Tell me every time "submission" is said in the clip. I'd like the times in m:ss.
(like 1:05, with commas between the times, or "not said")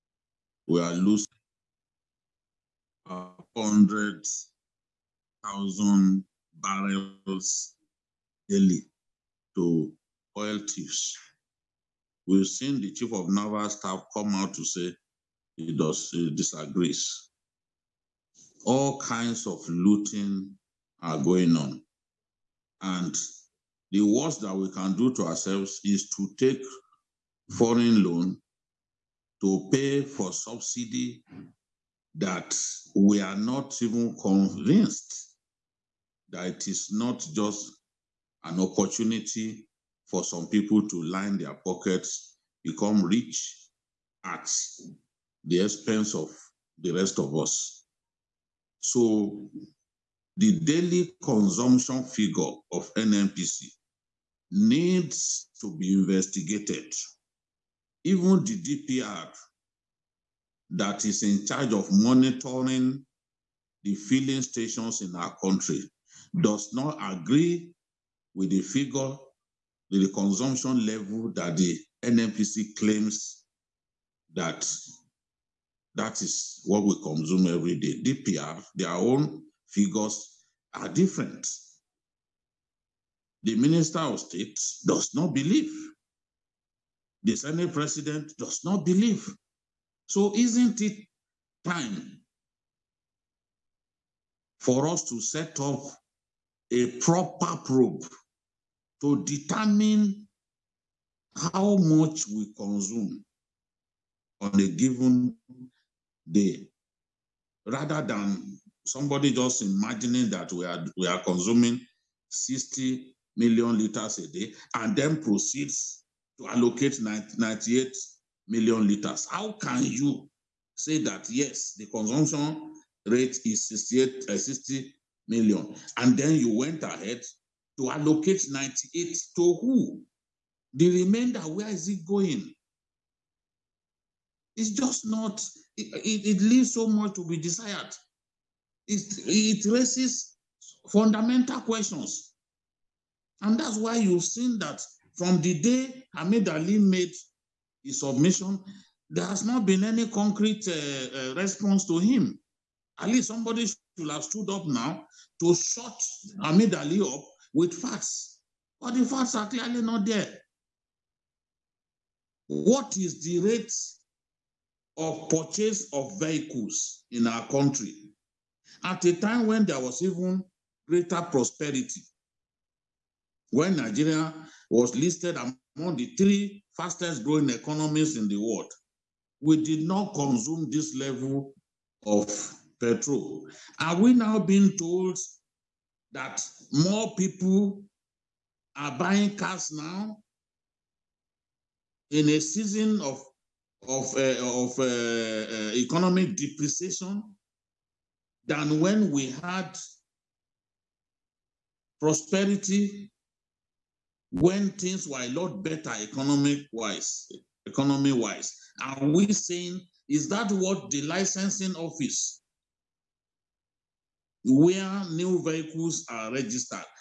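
2:27.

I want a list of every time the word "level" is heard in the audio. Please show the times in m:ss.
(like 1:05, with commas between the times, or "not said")
1:10, 3:00.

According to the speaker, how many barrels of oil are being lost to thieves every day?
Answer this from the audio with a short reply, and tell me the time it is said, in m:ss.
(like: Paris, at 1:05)
100,000 barrels, at 0:03.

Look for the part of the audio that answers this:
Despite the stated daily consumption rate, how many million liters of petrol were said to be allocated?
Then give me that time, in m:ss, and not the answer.
1:57.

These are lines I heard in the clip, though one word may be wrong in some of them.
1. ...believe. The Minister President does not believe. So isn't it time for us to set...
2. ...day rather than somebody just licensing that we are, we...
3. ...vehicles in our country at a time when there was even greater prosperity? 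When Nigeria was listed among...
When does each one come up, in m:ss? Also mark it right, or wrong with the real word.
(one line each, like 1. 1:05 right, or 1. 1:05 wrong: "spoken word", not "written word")
1. 1:25 wrong: "Senate", not "Minister"
2. 1:46 wrong: "imagining", not "licensing"
3. 2:46 right.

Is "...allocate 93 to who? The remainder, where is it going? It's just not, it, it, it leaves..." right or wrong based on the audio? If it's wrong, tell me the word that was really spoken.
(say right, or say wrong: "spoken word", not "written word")
wrong: "98", not "93".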